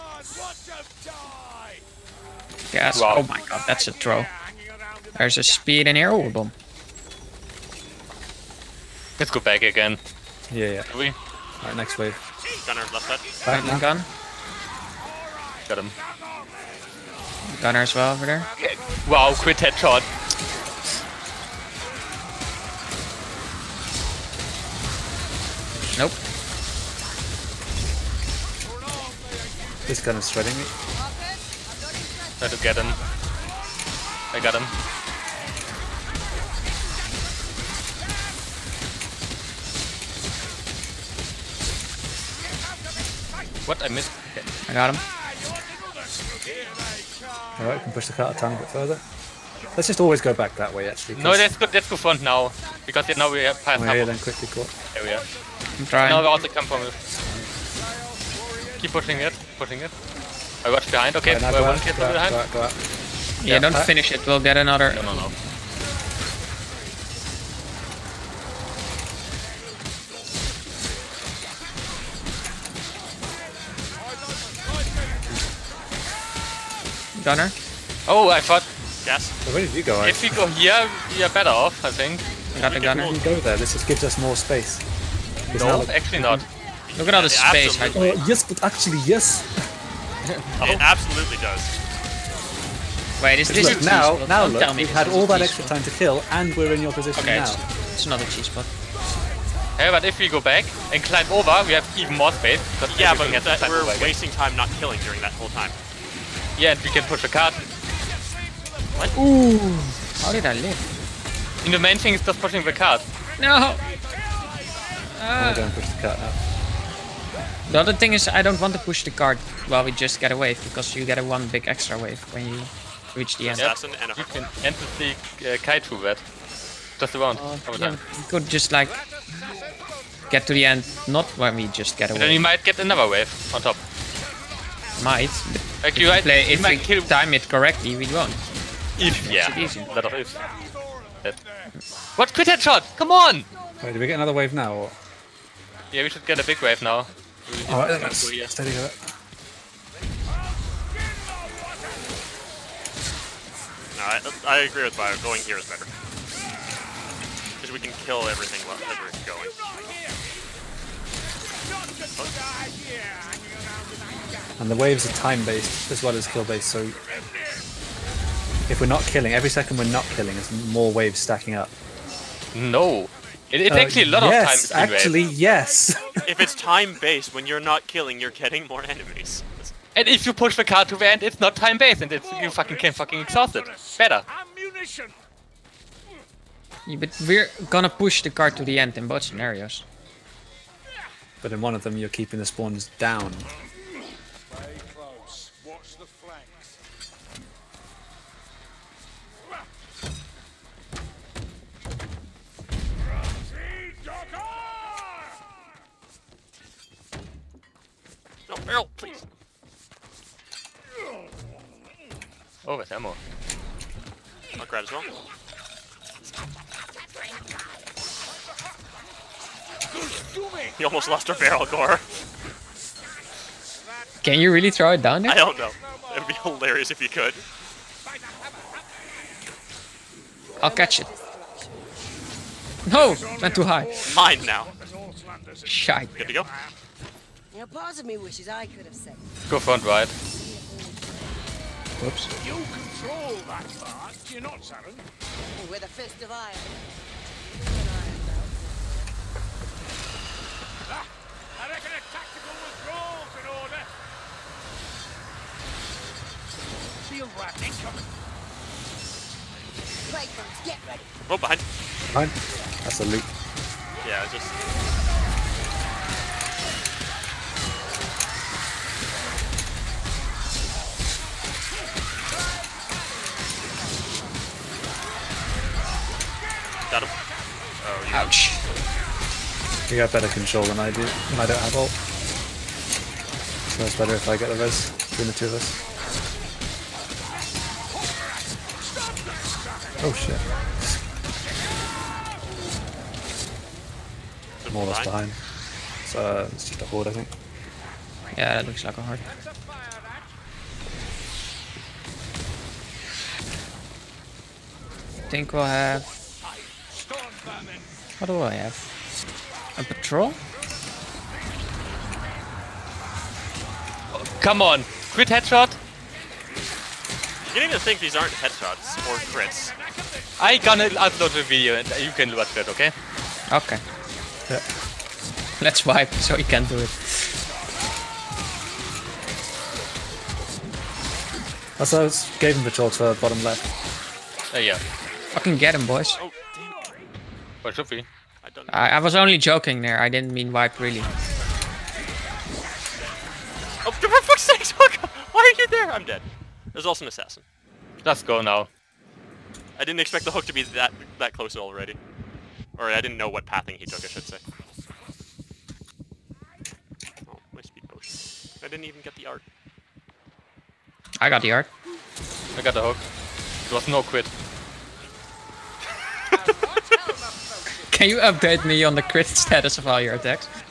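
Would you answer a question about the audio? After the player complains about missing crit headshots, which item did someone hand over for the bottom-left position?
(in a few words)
the torch.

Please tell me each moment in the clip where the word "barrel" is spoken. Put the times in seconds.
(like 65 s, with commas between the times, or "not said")
208 s, 221 s.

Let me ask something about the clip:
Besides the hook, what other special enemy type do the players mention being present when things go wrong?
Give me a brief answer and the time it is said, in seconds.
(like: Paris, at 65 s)
assassin, at 347 s.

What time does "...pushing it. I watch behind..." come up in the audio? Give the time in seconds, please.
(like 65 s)
59 s.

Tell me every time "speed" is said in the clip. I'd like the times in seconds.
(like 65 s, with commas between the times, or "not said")
5 s, 357 s.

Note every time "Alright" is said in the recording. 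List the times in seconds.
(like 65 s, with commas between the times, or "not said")
11 s, 47 s, 147 s.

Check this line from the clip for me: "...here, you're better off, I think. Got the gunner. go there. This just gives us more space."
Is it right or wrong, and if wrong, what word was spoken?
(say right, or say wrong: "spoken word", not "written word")
right.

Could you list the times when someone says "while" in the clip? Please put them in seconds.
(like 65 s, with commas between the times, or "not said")
119 s, 158 s.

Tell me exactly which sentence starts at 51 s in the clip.
No, let's go, good fun front now.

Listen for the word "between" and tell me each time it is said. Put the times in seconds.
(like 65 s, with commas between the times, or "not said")
285 s.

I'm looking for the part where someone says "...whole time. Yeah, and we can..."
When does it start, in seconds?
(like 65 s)
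105 s.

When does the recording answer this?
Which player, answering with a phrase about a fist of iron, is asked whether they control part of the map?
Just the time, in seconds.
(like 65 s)
244 s.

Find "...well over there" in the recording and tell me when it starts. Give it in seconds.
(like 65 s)
17 s.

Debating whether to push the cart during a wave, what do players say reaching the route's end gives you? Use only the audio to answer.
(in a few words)
one big extra wave.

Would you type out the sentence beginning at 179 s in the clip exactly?
And if you push the car to the end, it's not time based, and it's, you fucking can fucking exhaust it.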